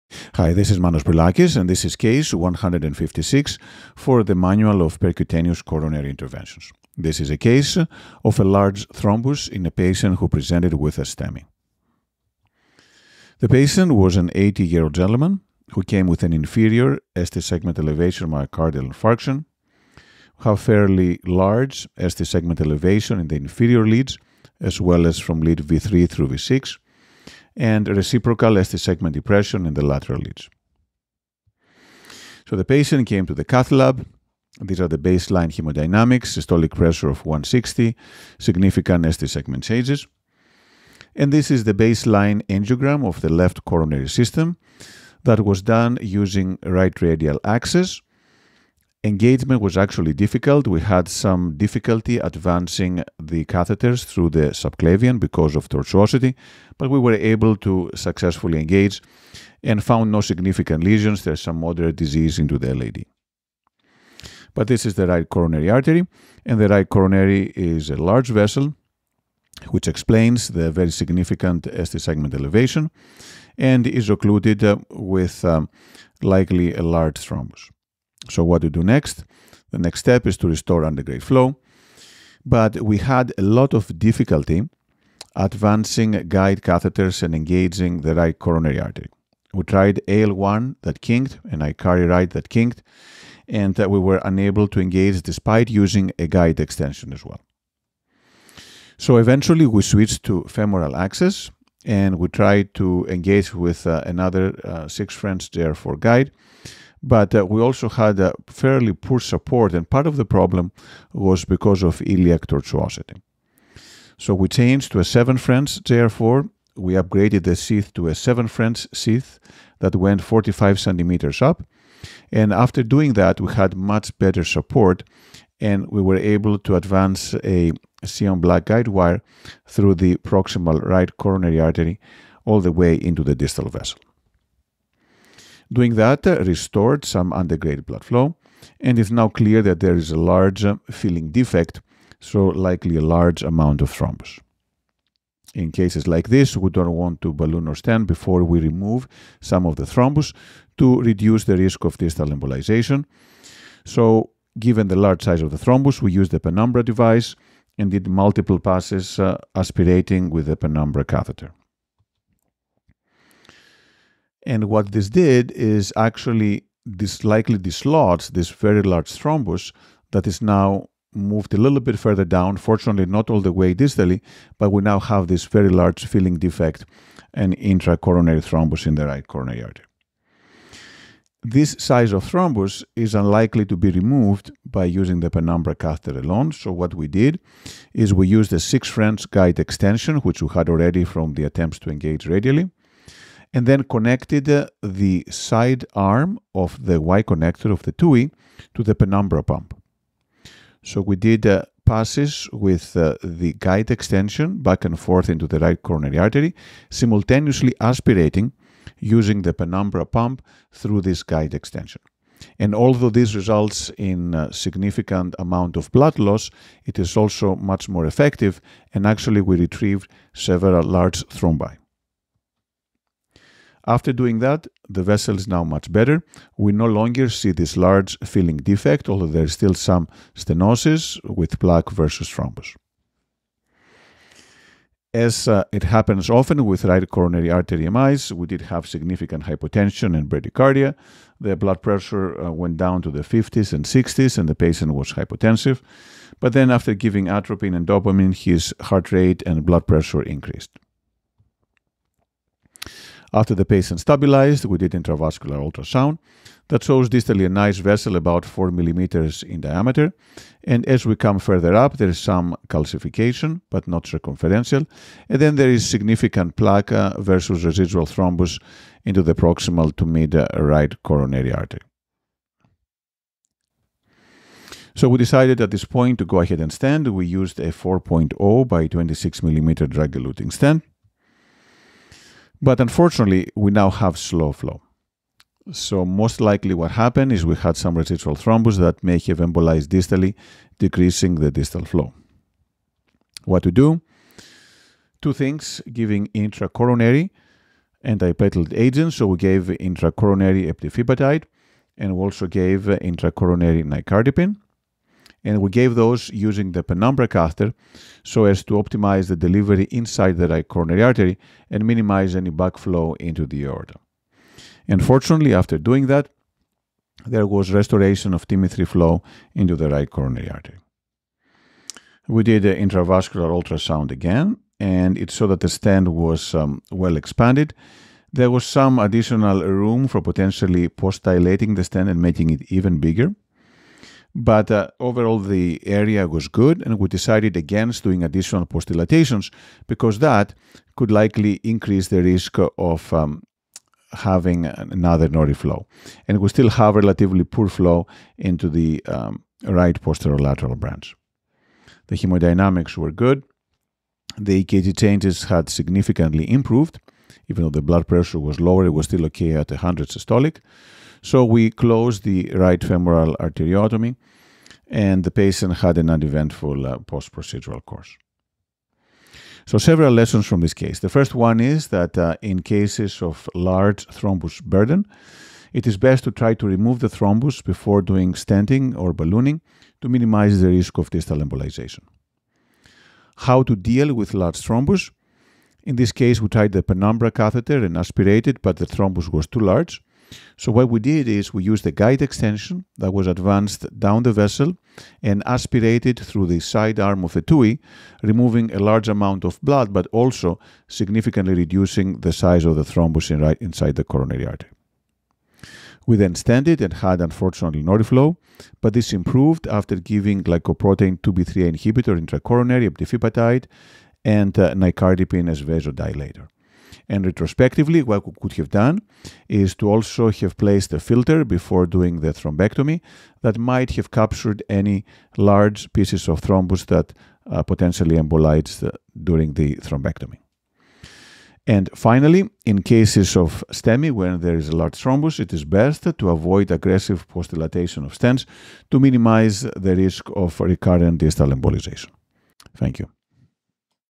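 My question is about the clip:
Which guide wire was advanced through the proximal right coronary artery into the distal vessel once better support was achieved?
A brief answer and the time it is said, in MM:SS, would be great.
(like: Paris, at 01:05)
Sion black, at 02:08.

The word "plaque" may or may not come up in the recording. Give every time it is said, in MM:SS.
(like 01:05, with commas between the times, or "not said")
03:51, 04:26.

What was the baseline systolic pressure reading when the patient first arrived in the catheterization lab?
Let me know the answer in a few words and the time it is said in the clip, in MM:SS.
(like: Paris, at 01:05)
160, at 00:37.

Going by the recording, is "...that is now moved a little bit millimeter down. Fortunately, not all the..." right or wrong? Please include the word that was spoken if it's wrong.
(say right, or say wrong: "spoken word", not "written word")
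wrong: "further", not "millimeter".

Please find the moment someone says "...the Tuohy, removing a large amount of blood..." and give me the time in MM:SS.
06:37.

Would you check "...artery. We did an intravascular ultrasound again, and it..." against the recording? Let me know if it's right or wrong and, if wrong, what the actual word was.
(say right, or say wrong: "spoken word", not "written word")
right.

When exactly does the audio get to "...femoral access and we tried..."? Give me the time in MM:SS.
01:40.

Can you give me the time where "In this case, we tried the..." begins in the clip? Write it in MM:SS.
06:25.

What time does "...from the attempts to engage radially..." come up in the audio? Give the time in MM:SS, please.
03:11.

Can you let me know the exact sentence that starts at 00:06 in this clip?
This is a case of a large thrombus in a patient who presented with a STEMI.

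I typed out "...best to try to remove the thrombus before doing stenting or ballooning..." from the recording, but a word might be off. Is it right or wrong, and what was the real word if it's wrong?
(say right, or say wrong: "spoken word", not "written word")
right.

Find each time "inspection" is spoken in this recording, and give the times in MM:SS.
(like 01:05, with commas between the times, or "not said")
not said.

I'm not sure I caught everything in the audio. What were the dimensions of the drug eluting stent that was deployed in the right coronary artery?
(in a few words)
4.0 by 26 millimeters.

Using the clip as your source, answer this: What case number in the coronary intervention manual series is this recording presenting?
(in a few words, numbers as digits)
156.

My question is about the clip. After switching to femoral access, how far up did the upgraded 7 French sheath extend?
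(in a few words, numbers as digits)
45 centimeters.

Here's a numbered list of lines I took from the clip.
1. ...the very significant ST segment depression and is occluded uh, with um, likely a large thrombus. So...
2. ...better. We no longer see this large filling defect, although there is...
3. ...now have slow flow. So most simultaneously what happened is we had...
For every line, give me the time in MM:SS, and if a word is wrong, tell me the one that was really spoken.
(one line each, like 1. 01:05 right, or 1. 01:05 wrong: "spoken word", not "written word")
1. 01:10 wrong: "elevation", not "depression"
2. 03:45 right
3. 04:43 wrong: "likely", not "simultaneously".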